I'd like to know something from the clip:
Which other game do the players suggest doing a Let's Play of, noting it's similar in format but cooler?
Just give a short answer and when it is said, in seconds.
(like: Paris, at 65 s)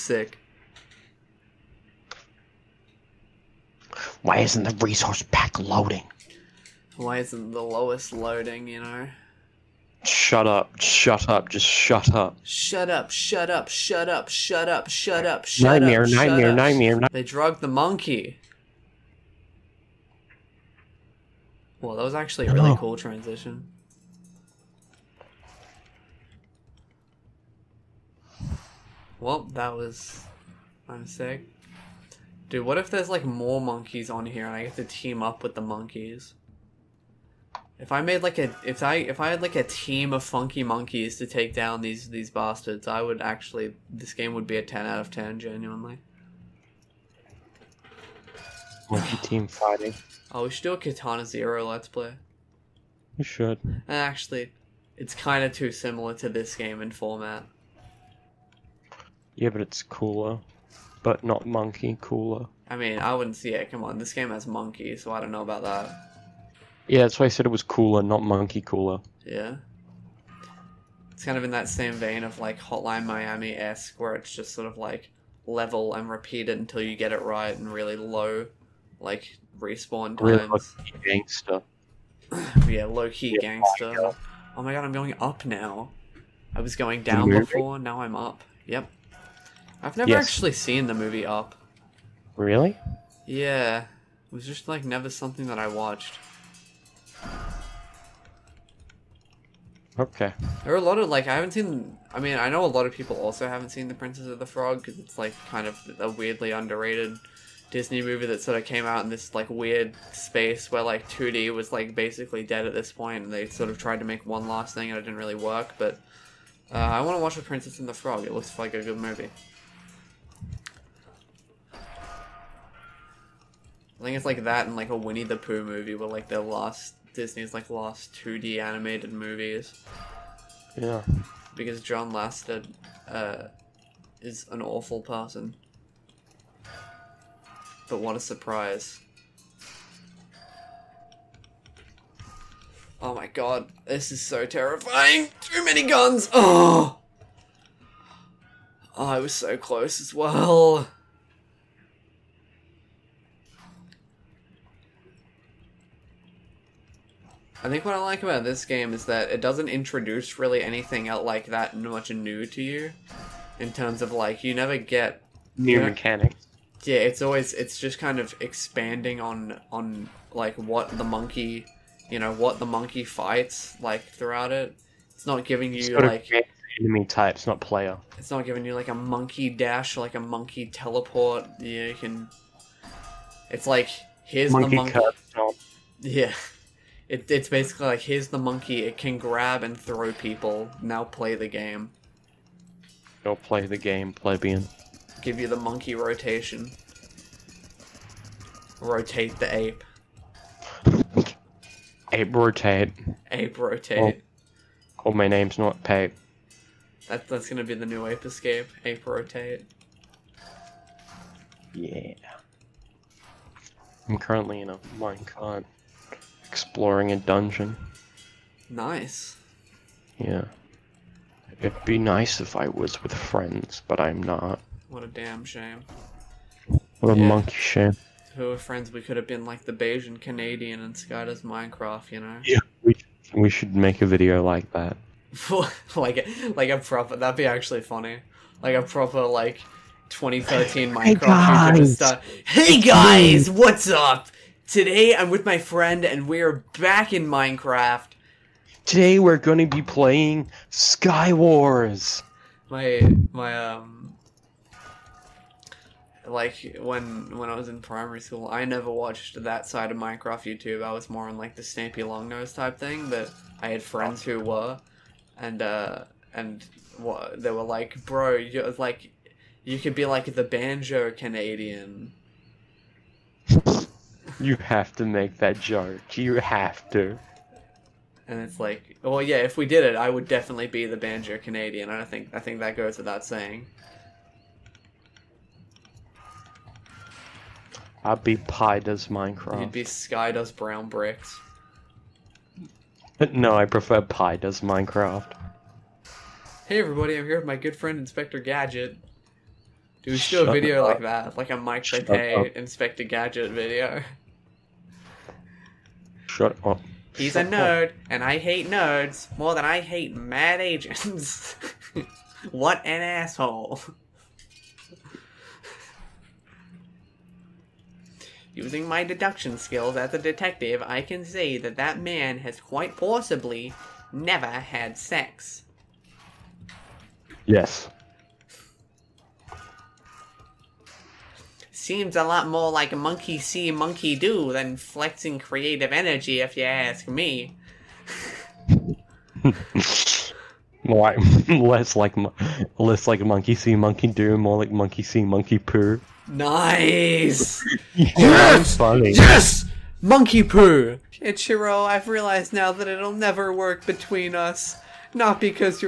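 Katana Zero, at 50 s.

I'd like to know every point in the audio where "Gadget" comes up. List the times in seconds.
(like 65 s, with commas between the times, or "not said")
298 s, 303 s.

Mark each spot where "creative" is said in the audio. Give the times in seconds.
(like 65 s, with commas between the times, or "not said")
335 s.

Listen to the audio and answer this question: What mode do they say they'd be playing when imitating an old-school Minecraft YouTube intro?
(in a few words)
Sky Wars.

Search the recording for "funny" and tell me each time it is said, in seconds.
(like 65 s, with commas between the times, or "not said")
237 s, 348 s.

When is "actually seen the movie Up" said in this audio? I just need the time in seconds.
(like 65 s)
90 s.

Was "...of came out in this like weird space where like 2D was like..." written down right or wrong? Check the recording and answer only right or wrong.
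right.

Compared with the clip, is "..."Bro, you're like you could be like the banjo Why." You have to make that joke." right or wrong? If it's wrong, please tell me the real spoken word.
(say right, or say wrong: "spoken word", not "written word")
wrong: "Canadian", not "Why".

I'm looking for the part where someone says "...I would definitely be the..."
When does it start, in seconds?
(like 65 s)
279 s.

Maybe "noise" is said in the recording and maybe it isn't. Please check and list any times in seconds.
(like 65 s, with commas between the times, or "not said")
not said.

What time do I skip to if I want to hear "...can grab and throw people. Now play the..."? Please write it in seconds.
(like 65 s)
188 s.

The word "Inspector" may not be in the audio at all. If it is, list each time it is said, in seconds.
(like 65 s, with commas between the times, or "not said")
297 s, 302 s.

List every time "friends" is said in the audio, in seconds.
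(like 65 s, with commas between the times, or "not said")
223 s, 228 s, 245 s, 263 s, 297 s.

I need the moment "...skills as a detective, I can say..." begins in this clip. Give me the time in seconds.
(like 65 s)
319 s.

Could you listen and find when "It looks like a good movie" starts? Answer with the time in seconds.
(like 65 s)
118 s.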